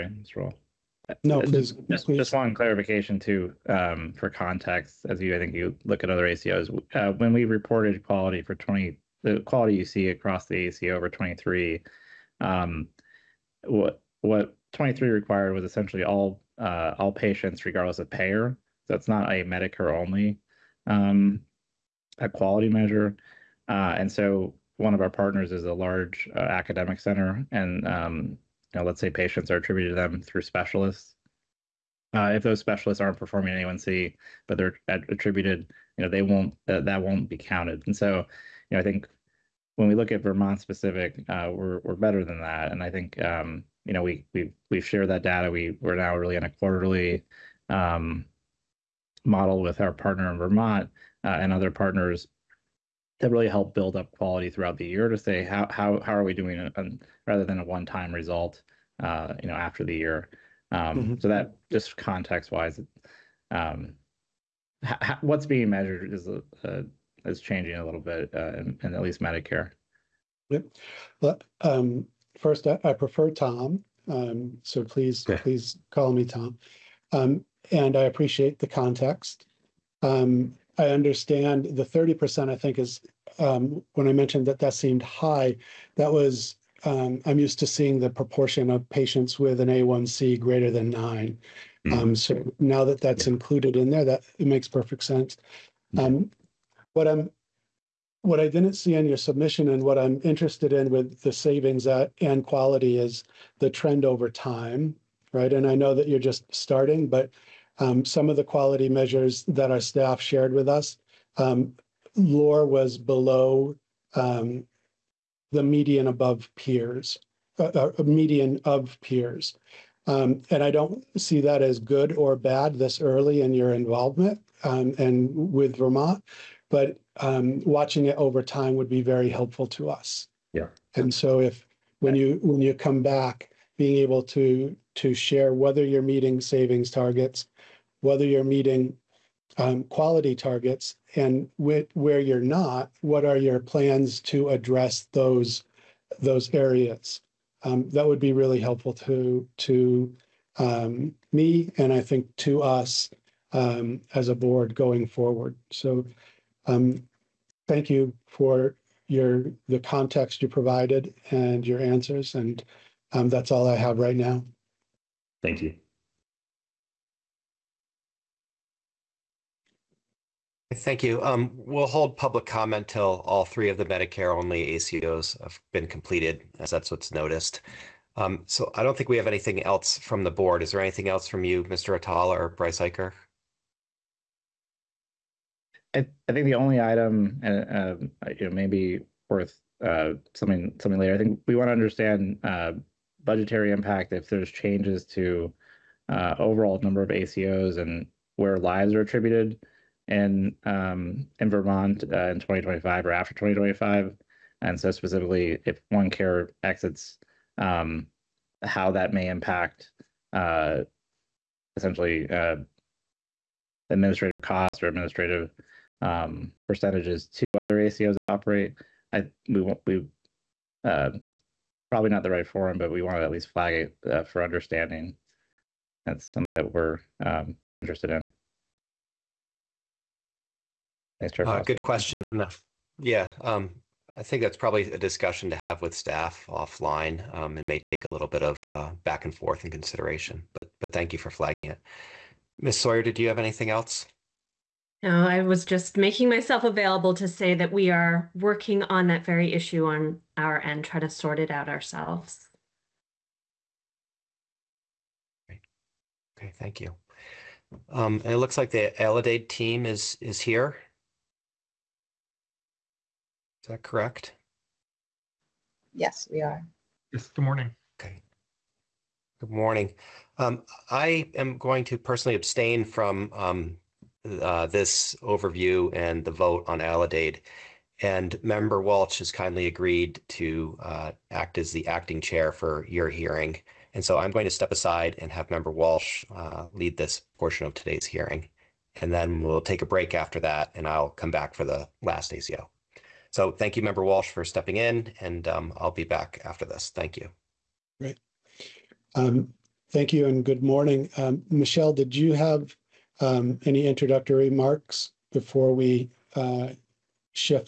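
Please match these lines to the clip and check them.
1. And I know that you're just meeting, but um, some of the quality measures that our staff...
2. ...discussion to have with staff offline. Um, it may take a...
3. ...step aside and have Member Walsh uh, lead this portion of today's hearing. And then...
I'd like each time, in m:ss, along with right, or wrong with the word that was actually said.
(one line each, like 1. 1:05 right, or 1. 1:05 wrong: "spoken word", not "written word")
1. 1:45 wrong: "starting", not "meeting"
2. 3:54 right
3. 4:44 right.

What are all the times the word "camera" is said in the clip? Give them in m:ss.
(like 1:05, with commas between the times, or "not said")
not said.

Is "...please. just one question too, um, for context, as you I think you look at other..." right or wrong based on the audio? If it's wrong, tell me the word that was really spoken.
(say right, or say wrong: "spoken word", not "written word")
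wrong: "clarification", not "question".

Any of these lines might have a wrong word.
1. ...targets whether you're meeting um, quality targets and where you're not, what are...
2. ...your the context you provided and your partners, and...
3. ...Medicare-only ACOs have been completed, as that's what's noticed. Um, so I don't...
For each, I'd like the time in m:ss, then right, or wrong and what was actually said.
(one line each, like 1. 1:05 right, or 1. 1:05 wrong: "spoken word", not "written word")
1. 2:16 right
2. 2:39 wrong: "answers", not "partners"
3. 2:53 right.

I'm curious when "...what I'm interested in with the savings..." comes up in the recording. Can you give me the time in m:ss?
1:39.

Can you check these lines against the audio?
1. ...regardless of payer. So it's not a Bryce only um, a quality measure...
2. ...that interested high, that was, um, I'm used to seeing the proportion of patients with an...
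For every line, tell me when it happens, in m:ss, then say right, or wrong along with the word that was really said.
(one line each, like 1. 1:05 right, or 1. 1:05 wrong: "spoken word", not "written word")
1. 0:17 wrong: "Medicare", not "Bryce"
2. 1:24 wrong: "seemed", not "interested".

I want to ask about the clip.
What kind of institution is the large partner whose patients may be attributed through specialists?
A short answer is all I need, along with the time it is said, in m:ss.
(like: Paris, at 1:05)
academic center, at 0:26.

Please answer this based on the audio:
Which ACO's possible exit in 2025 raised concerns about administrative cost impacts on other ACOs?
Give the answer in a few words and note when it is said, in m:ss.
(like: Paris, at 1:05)
OneCare, at 3:25.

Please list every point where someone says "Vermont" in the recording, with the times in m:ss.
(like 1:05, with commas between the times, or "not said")
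0:40, 0:50, 2:05, 3:21.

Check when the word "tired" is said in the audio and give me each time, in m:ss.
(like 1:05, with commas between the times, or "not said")
not said.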